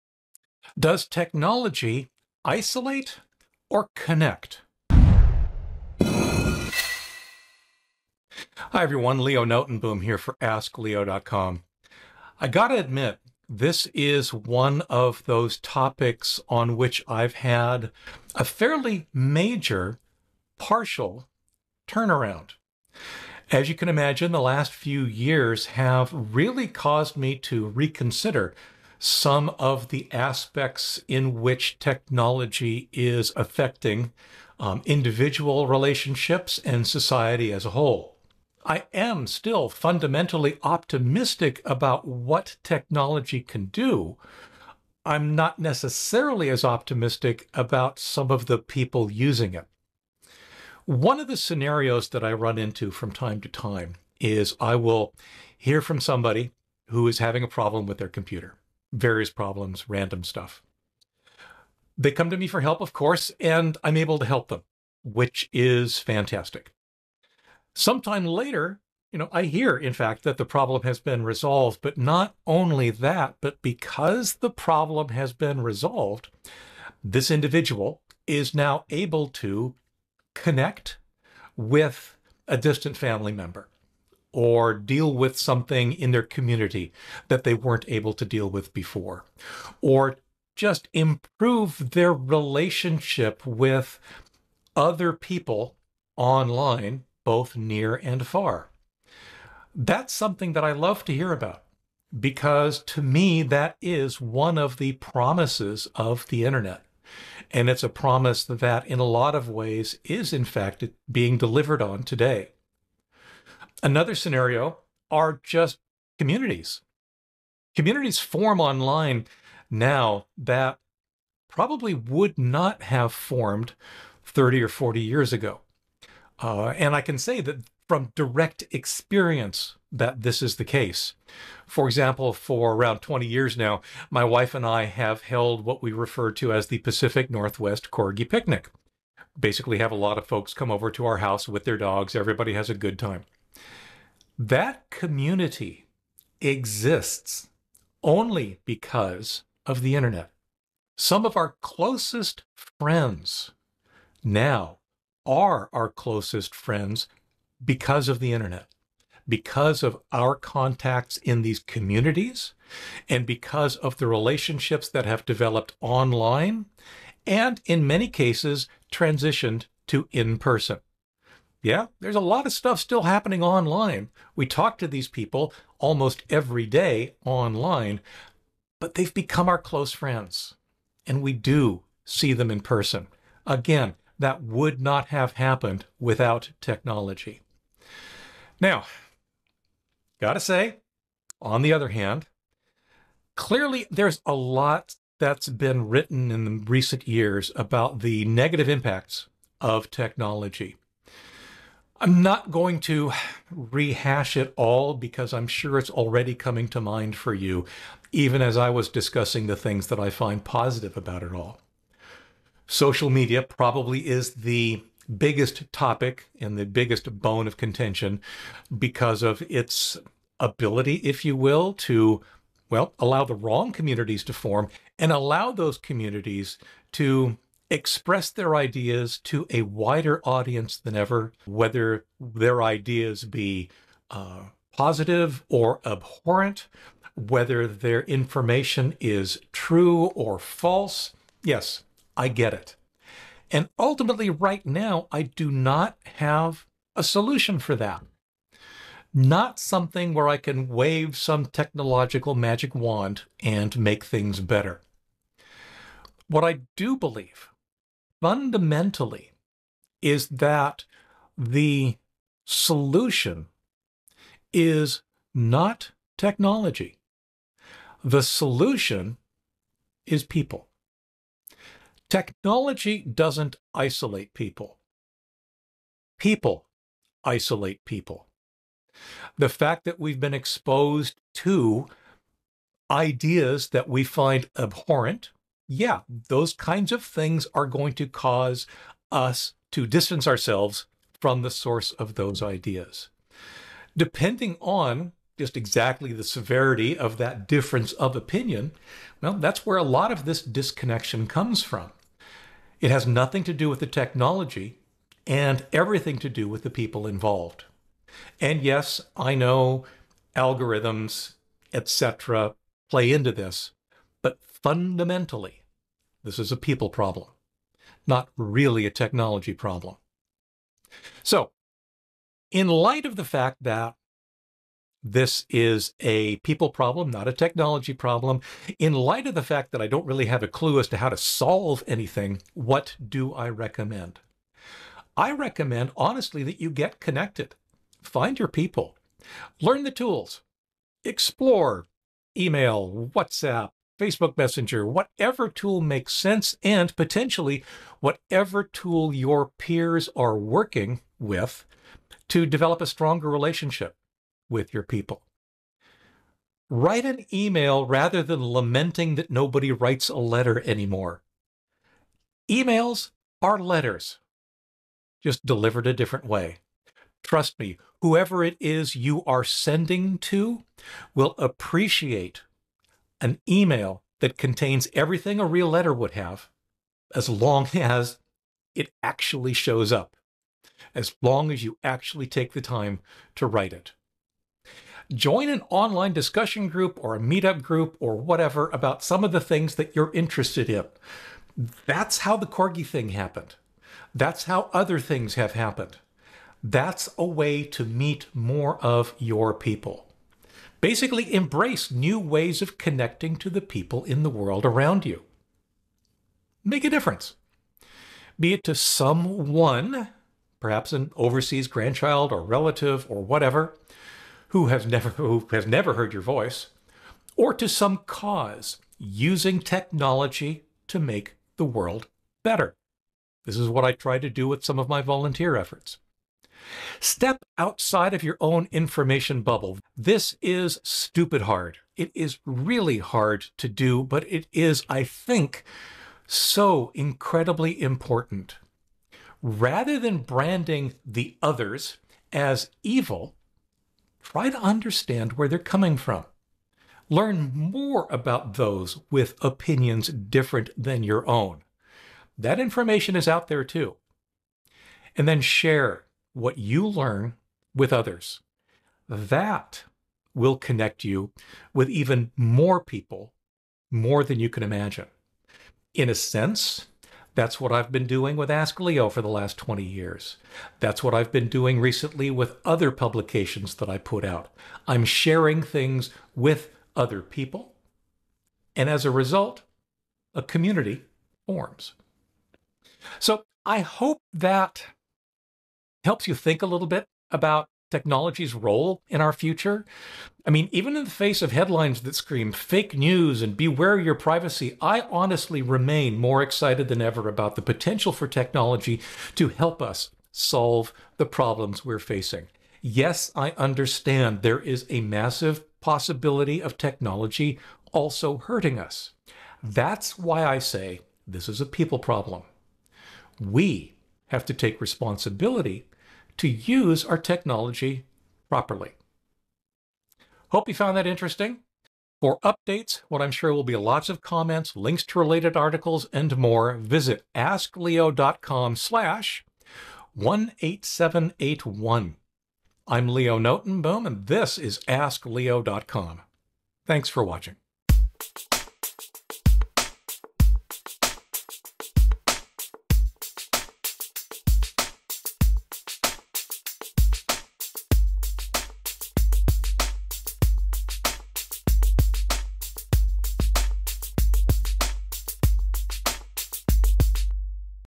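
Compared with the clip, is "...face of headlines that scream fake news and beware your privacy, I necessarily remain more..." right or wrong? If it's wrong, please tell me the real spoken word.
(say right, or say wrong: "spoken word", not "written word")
wrong: "honestly", not "necessarily".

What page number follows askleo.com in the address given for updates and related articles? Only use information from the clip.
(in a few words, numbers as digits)
18781.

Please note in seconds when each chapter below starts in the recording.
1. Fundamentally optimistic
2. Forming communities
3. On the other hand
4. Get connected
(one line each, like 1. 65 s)
1. 40 s
2. 110 s
3. 190 s
4. 320 s.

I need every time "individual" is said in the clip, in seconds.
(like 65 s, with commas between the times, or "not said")
34 s, 77 s.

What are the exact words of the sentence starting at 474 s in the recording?
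I'm sharing things with other people.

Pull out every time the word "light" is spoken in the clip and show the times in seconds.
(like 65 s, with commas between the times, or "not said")
322 s, 328 s.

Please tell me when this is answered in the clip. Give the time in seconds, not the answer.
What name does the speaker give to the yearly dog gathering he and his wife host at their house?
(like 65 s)
136 s.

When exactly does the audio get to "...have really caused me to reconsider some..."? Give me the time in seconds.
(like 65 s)
25 s.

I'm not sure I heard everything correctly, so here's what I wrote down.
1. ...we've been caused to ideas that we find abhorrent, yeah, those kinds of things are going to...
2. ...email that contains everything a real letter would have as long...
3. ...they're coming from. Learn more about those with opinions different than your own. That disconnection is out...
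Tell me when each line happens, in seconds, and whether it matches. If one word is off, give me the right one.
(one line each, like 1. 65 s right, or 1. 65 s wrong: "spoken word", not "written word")
1. 279 s wrong: "exposed", not "caused"
2. 373 s right
3. 445 s wrong: "information", not "disconnection".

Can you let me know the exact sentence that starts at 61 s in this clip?
They come to me for help, of course, and I'm able to help them, which is fantastic.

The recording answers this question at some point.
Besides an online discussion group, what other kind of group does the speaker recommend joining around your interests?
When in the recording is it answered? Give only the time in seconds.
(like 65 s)
387 s.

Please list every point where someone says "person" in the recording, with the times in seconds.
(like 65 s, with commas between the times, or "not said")
170 s, 182 s.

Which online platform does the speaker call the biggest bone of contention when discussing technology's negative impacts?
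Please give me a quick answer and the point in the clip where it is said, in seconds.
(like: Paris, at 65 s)
Social media, at 212 s.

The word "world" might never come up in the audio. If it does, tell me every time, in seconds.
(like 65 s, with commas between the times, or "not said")
404 s, 421 s.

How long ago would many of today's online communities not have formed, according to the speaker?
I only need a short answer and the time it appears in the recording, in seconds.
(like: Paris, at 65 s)
30 or 40 years, at 124 s.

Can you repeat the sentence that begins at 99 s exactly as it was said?
That's something that I love to hear about because to me, that is one of the promises of the internet.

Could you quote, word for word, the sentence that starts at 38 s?
I am still fundamentally optimistic about what technology can do.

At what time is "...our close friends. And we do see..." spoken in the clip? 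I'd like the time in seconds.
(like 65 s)
179 s.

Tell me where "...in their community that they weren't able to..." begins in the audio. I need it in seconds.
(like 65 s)
85 s.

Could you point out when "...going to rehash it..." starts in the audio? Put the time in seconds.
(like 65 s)
202 s.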